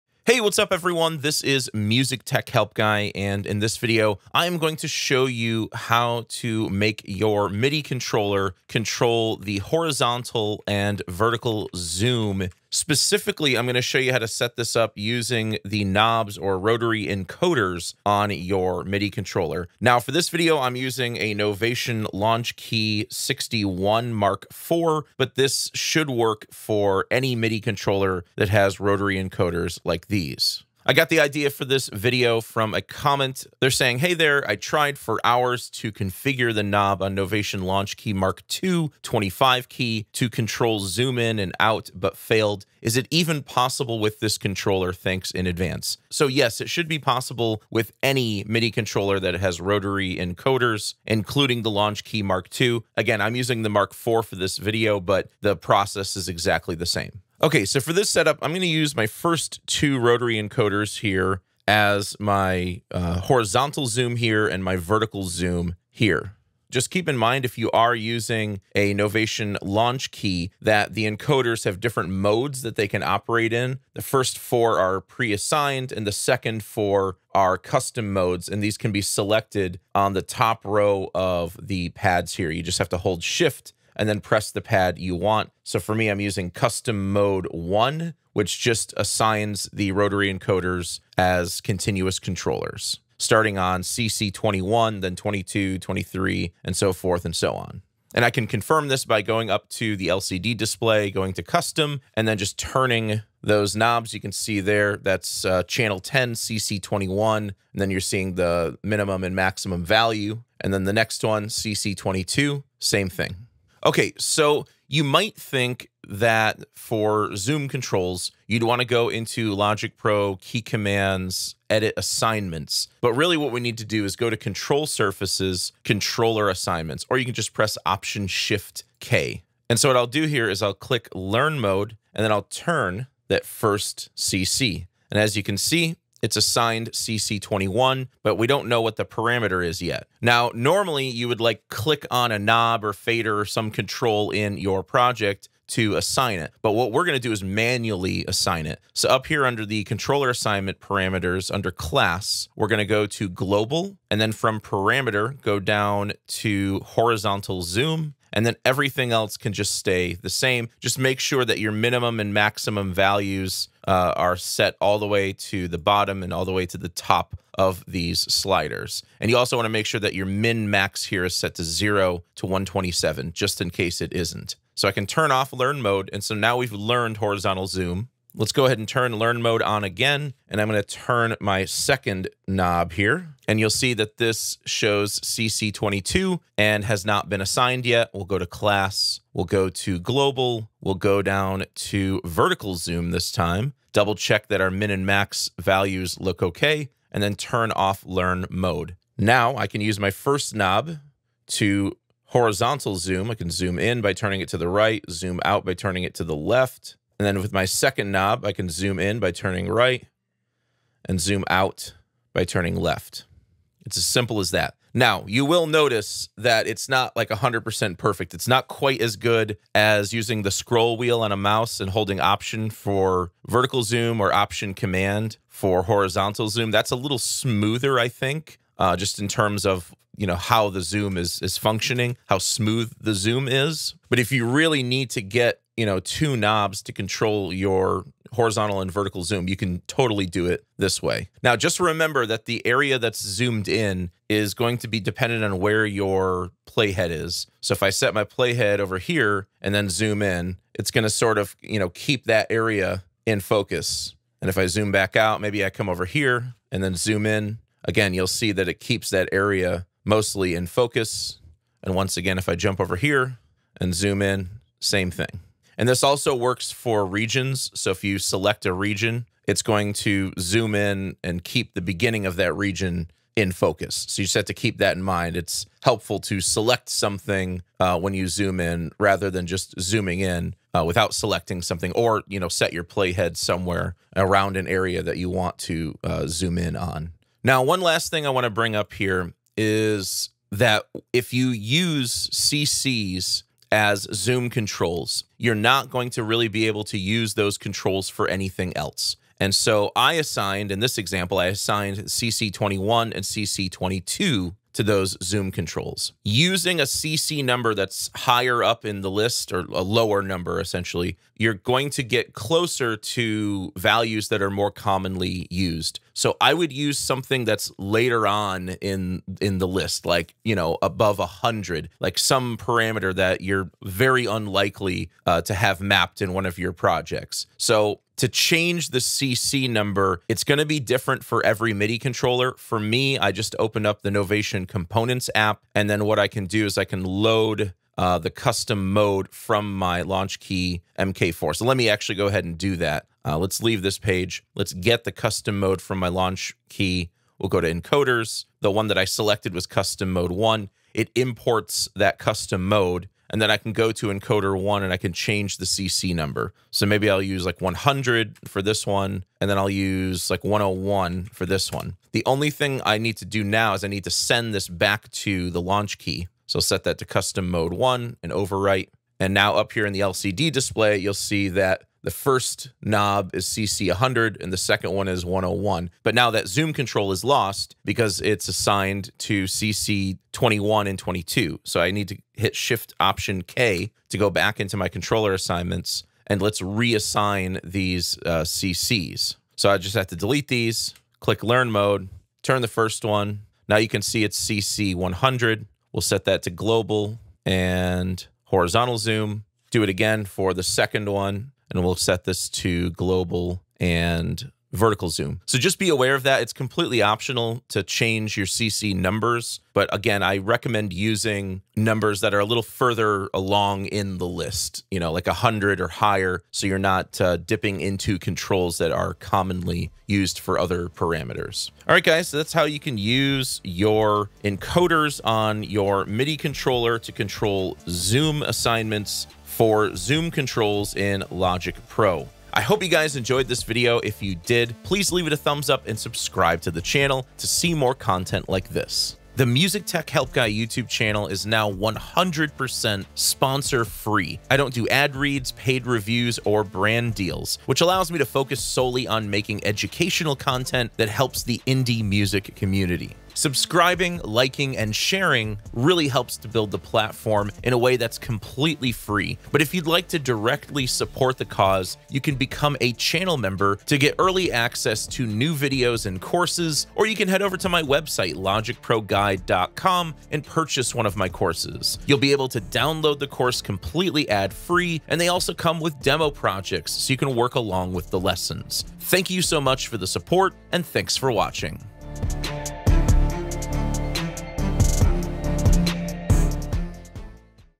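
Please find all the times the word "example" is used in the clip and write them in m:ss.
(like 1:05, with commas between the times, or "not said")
5:00.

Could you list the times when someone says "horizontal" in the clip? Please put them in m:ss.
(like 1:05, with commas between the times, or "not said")
0:09, 1:03, 2:36, 2:57, 3:22, 3:45, 3:58, 6:38.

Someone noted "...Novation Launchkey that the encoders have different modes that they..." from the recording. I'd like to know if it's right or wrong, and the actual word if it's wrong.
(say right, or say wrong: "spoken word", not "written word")
right.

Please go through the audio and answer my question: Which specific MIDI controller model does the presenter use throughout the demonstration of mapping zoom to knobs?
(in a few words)
Novation Launchkey 61 Mark IV.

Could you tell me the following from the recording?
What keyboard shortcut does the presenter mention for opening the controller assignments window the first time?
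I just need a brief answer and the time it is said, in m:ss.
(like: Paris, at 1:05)
Option Shift K, at 2:07.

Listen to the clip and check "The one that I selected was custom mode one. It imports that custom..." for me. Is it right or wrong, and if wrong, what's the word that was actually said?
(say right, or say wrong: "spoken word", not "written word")
right.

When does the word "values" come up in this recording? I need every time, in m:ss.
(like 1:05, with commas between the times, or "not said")
1:49, 2:42, 3:15, 5:13.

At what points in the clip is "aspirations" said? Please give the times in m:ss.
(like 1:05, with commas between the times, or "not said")
not said.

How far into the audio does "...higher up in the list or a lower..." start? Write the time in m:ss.
5:08.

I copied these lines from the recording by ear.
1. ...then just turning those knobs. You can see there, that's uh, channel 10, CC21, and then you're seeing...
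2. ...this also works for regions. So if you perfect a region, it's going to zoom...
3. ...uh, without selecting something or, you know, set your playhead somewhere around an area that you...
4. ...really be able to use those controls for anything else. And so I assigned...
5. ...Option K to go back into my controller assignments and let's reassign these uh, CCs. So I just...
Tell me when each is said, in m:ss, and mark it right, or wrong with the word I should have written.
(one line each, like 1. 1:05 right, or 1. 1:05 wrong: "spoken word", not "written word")
1. 1:42 right
2. 4:25 wrong: "select", not "perfect"
3. 4:40 right
4. 4:56 right
5. 6:22 right.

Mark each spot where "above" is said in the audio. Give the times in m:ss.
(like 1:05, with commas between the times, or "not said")
5:20.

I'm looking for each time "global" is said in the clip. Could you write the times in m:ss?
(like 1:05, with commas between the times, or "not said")
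2:33, 3:09, 6:36, 6:42.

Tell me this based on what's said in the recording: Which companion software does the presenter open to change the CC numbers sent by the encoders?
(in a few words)
Novation Components.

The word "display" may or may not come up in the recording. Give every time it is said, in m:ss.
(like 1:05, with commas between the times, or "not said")
1:40, 6:10.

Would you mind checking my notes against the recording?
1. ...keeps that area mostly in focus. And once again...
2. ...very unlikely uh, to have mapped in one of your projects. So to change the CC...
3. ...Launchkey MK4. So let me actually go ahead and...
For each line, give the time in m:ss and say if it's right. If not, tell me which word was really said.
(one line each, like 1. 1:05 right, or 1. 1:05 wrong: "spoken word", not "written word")
1. 4:18 right
2. 5:23 right
3. 5:40 right.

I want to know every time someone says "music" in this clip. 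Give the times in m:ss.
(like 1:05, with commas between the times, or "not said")
0:01, 7:19, 7:32.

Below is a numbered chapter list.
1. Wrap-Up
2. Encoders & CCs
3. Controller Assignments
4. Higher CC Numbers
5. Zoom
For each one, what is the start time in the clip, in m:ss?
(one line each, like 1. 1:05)
1. 7:01
2. 0:56
3. 1:54
4. 4:47
5. 3:18.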